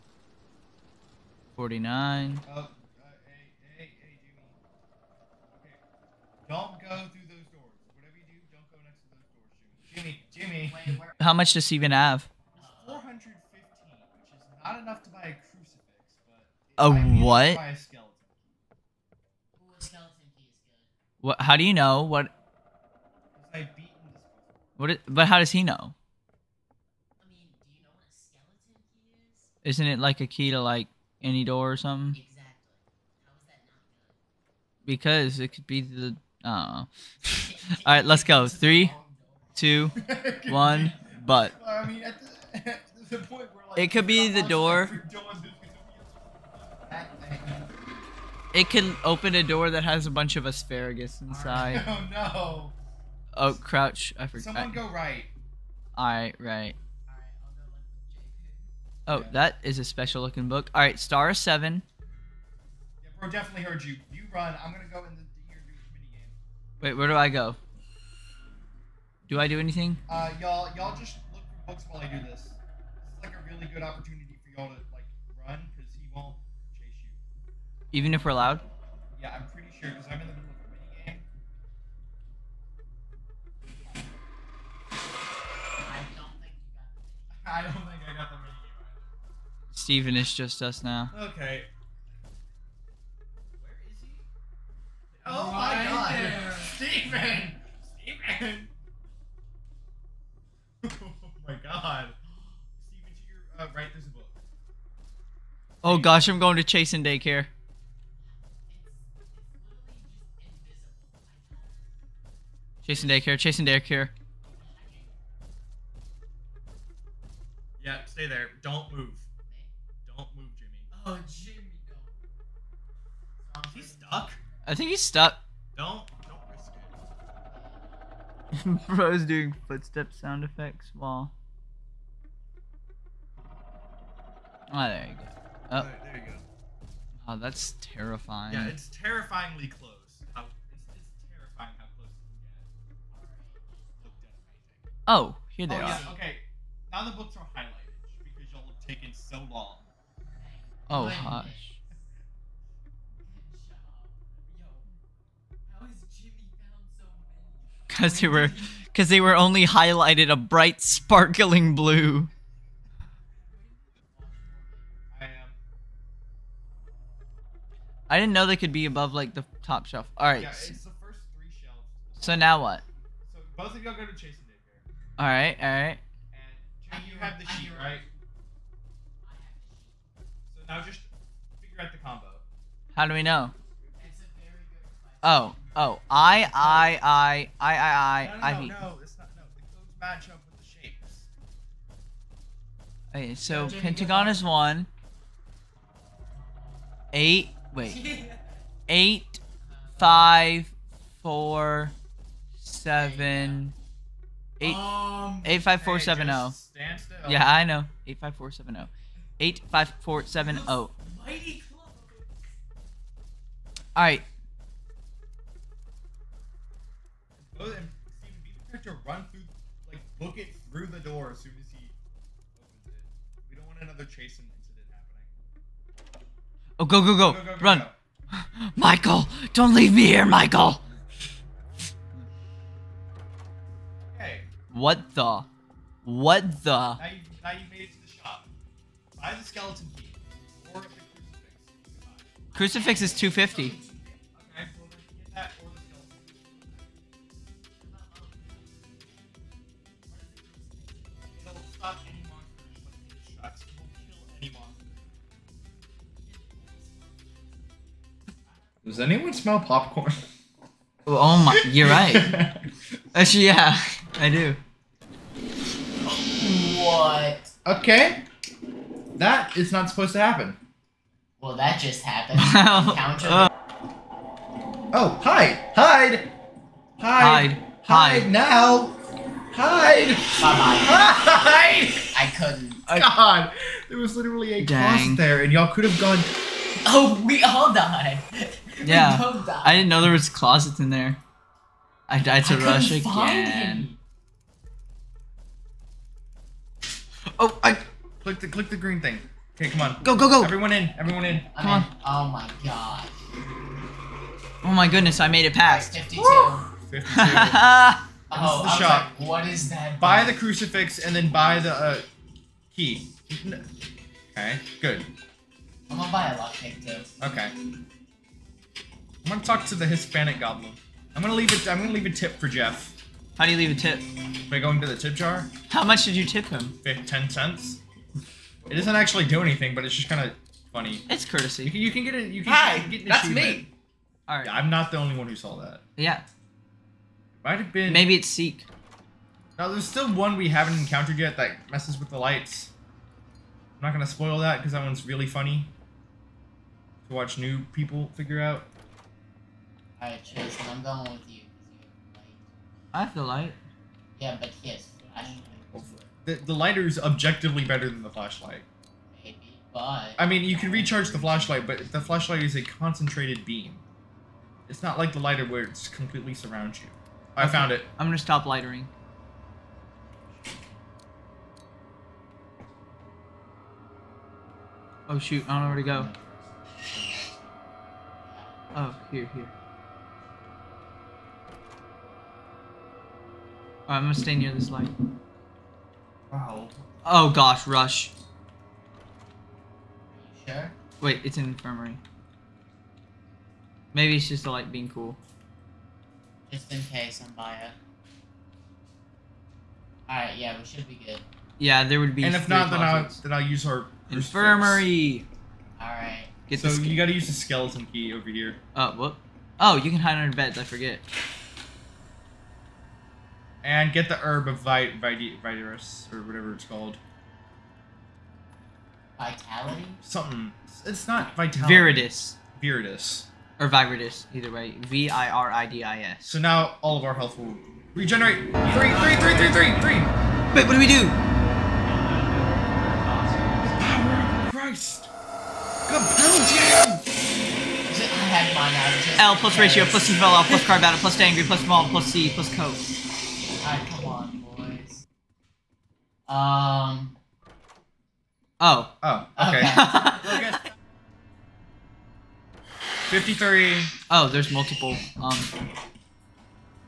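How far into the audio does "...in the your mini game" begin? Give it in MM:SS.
01:04.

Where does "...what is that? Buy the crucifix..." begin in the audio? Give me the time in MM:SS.
05:09.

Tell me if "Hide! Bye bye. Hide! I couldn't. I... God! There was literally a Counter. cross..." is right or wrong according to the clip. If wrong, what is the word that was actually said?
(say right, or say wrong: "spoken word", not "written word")
wrong: "Dang", not "Counter".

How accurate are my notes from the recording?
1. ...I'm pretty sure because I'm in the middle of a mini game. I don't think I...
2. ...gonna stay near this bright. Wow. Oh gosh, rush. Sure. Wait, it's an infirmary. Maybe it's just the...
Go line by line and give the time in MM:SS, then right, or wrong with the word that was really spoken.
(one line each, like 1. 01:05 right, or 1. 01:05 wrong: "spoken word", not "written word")
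1. 01:19 right
2. 06:24 wrong: "light", not "bright".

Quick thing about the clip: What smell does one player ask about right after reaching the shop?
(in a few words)
Popcorn.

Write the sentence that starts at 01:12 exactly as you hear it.
This is like a really good opportunity for y'all to like run.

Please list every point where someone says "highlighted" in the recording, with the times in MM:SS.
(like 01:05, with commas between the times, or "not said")
02:27, 02:39.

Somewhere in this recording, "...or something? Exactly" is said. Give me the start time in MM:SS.
00:31.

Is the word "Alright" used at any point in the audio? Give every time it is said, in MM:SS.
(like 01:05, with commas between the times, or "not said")
05:50, 06:40, 06:45, 07:23.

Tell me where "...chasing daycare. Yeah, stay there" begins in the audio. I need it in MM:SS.
01:53.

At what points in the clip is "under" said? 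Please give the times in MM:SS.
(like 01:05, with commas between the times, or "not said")
06:50.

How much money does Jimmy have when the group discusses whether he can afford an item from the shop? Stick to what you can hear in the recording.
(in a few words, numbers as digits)
415.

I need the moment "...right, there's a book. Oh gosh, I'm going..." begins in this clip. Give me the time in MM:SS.
01:43.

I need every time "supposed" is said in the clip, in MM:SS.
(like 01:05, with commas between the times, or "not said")
04:29.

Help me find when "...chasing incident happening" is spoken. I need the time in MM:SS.
03:44.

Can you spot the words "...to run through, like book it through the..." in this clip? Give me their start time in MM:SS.
03:38.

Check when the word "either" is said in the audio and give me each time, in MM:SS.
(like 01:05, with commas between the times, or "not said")
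01:28, 07:04.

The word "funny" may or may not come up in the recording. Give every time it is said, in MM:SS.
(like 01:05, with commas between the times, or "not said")
05:30, 05:45.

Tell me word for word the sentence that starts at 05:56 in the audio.
The, the lighter is objectively better than the flashlight.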